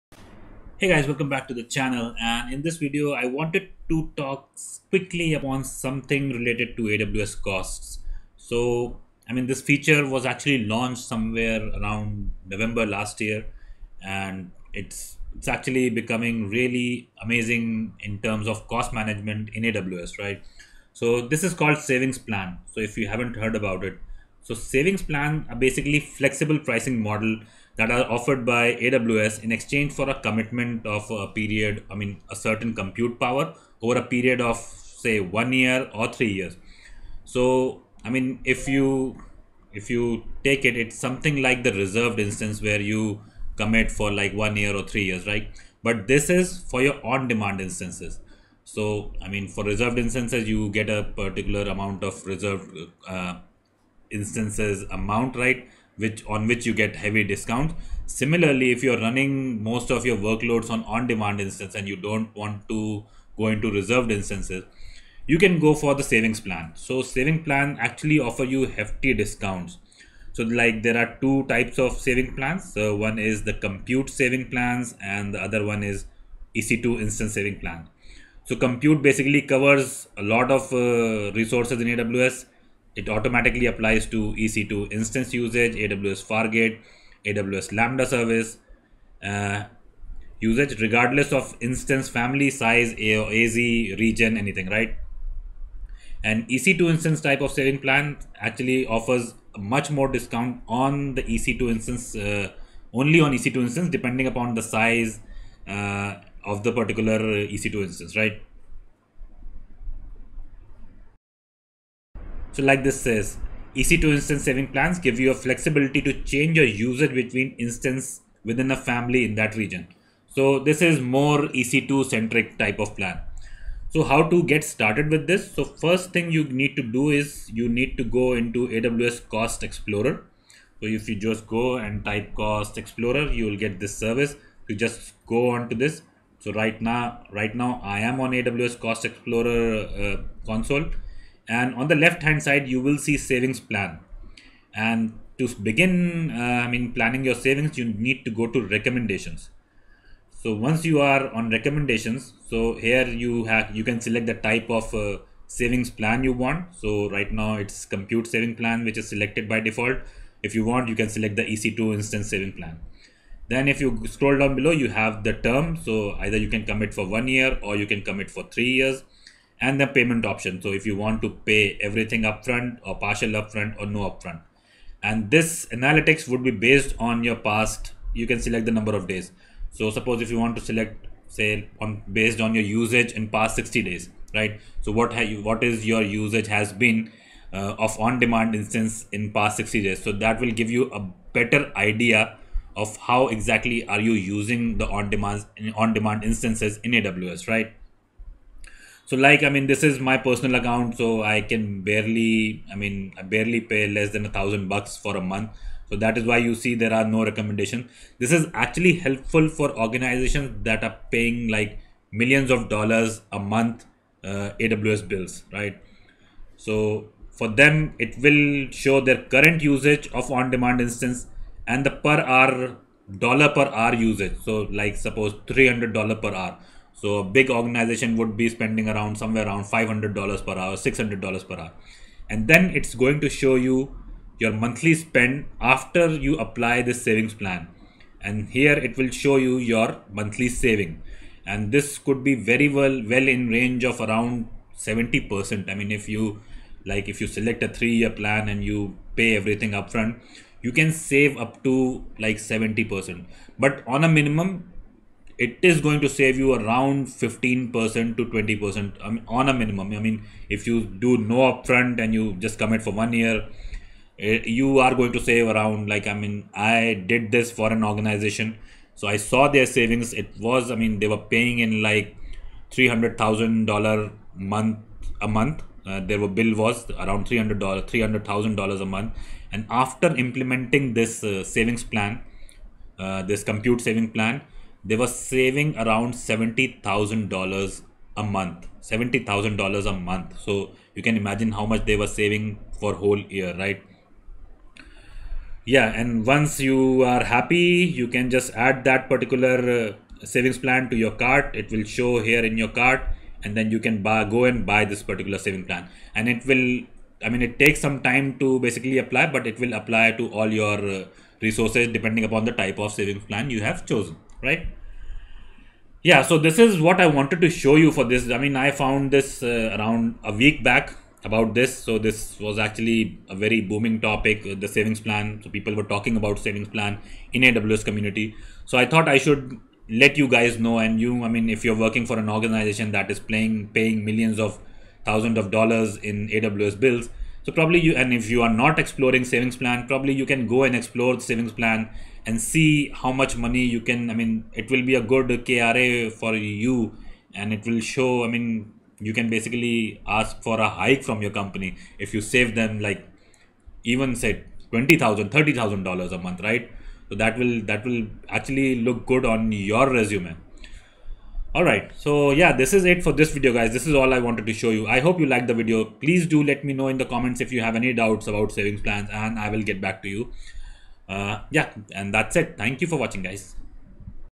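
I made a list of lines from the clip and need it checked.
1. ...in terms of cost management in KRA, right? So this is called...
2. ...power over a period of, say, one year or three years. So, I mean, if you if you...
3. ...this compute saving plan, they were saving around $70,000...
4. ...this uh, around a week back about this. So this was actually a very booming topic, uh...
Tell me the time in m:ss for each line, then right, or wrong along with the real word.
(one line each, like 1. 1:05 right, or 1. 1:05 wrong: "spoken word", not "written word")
1. 0:17 wrong: "AWS", not "KRA"
2. 0:33 right
3. 4:43 right
4. 5:19 right.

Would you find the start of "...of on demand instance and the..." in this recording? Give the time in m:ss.
3:40.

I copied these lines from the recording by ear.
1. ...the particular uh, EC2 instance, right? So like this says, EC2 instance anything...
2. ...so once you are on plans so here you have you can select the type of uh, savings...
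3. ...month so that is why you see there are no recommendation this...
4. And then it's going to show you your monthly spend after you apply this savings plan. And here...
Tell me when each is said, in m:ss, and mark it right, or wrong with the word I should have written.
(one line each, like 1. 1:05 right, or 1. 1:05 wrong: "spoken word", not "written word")
1. 1:46 wrong: "saving", not "anything"
2. 2:30 wrong: "recommendations", not "plans"
3. 3:25 right
4. 3:52 right.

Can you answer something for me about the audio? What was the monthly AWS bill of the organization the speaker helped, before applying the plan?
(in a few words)
$300,000.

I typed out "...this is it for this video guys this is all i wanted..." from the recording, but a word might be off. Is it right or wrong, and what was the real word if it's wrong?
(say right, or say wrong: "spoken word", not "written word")
right.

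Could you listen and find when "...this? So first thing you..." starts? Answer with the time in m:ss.
2:05.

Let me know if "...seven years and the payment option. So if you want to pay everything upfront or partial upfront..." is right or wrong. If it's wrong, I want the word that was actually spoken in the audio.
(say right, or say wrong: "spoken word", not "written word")
wrong: "three", not "seven".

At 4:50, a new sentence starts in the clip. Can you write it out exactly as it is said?
So you can imagine how much they were saving for whole year, right?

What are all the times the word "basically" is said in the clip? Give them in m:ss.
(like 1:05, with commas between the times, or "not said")
0:25, 1:19, 5:08, 5:49.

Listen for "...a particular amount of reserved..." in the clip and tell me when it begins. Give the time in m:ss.
0:50.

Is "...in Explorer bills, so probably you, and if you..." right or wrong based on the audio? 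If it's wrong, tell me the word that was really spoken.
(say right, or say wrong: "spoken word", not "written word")
wrong: "AWS", not "Explorer".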